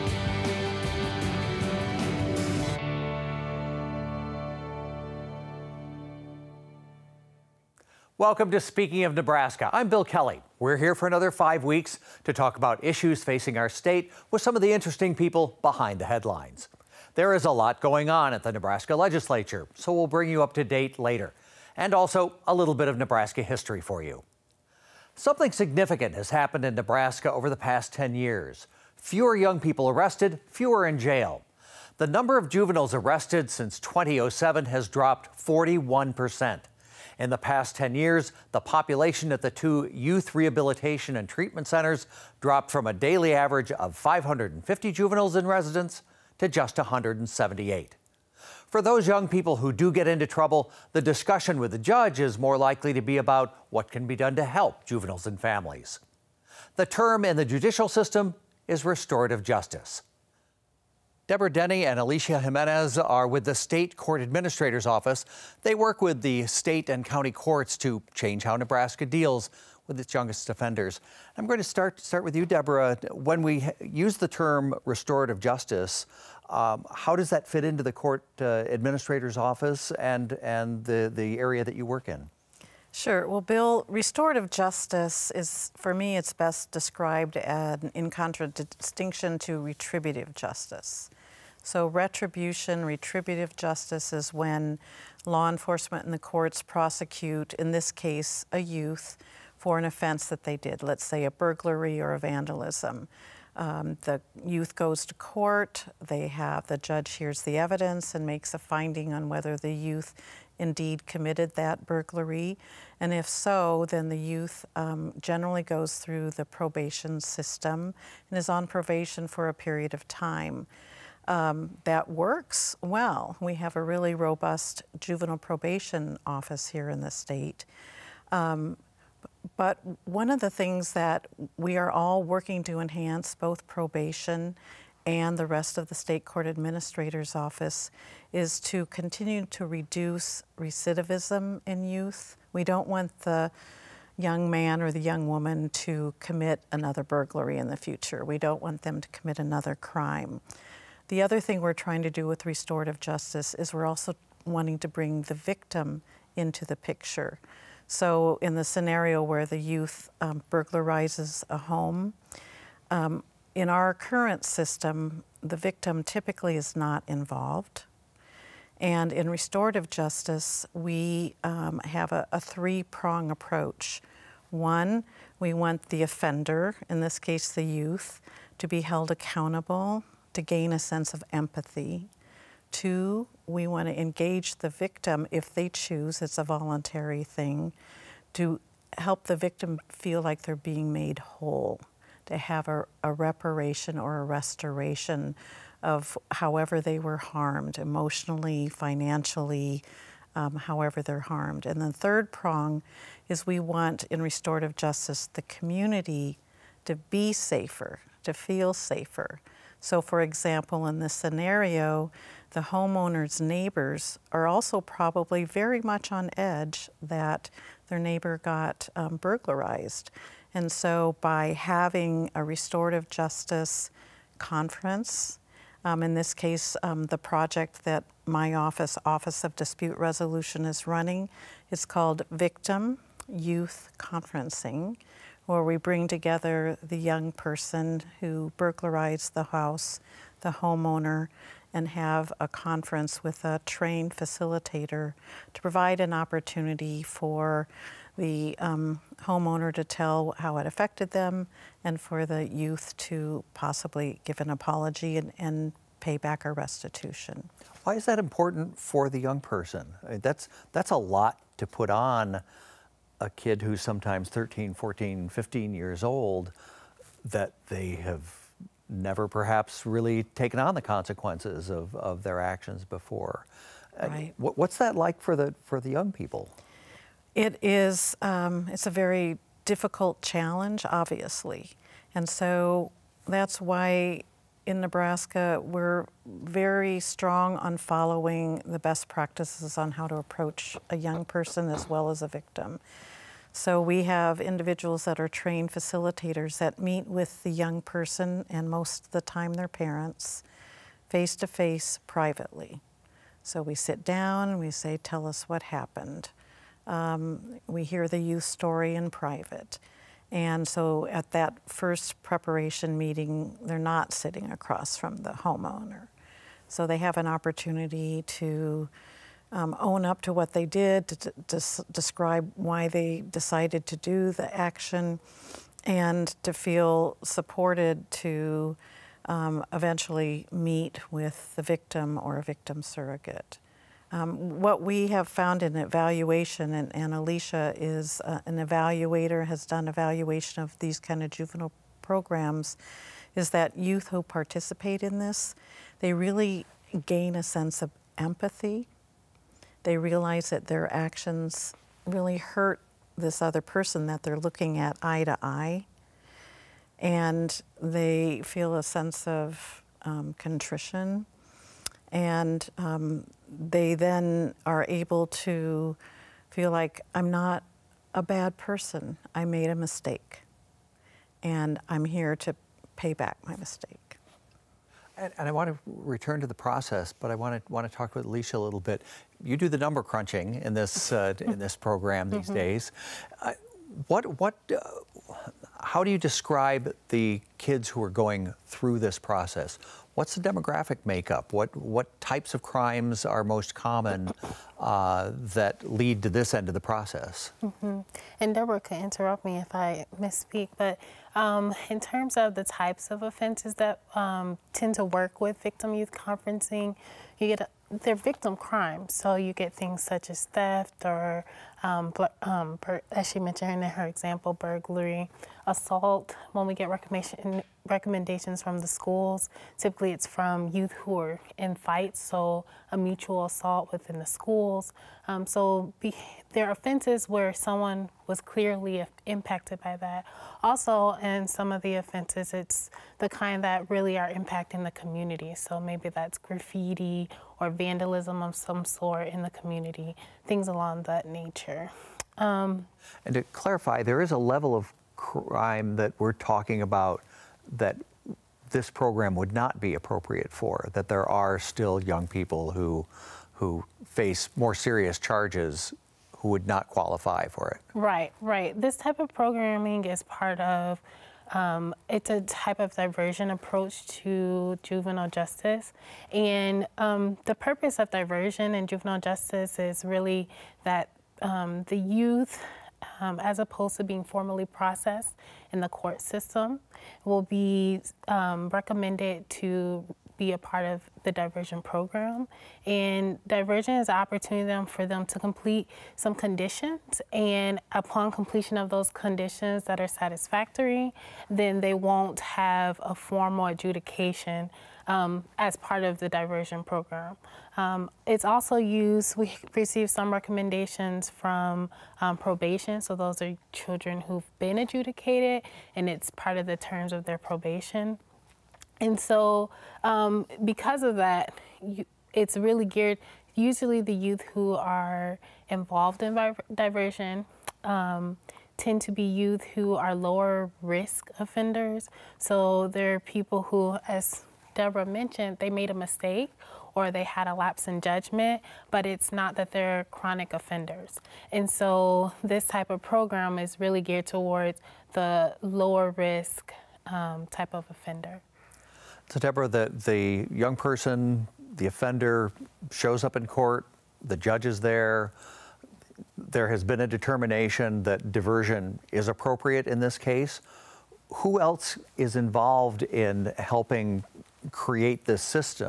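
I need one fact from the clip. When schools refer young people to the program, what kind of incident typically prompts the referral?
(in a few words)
fights.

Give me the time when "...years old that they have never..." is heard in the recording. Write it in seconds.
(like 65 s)
265 s.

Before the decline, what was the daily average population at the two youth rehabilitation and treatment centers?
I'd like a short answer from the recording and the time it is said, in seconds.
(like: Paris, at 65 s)
550, at 43 s.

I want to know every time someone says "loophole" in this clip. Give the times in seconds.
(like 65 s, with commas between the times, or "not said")
not said.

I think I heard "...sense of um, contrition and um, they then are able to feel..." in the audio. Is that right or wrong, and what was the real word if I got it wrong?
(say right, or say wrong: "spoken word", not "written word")
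right.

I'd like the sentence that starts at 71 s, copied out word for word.
I'm going to start start with you, Deborah.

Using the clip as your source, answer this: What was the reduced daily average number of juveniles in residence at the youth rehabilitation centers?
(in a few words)
178.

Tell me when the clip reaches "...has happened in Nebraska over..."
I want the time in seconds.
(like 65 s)
26 s.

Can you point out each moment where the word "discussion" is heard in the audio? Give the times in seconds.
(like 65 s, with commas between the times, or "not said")
51 s.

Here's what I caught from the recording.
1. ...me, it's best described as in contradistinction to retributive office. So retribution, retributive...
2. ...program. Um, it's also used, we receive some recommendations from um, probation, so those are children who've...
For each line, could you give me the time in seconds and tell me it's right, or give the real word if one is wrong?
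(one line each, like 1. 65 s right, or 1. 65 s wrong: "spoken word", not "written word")
1. 85 s wrong: "justice", not "office"
2. 496 s right.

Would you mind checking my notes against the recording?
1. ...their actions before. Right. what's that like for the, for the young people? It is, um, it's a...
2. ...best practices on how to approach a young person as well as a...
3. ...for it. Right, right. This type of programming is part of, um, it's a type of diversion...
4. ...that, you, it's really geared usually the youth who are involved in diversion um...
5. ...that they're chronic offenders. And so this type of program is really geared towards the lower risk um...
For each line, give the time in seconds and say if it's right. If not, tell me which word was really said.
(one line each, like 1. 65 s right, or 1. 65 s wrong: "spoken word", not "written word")
1. 272 s right
2. 288 s right
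3. 457 s right
4. 511 s right
5. 529 s right.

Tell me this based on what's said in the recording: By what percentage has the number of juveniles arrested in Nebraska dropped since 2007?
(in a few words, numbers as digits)
41 percent.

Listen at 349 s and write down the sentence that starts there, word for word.
They realize that their actions really hurt this other person that they're looking at eye to eye.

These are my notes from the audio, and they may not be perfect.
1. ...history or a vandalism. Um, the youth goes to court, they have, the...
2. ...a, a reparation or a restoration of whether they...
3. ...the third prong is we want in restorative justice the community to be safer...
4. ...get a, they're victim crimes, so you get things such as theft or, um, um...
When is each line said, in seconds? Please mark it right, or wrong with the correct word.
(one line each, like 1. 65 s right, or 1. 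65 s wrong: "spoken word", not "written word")
1. 101 s wrong: "burglary", not "history"
2. 192 s wrong: "however", not "whether"
3. 201 s right
4. 407 s right.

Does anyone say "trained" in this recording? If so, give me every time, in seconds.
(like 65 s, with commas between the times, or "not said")
243 s, 295 s.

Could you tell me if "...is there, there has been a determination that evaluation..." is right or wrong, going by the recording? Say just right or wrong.
wrong.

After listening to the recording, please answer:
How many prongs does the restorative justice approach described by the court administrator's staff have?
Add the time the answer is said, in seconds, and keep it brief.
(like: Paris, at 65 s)
3, at 172 s.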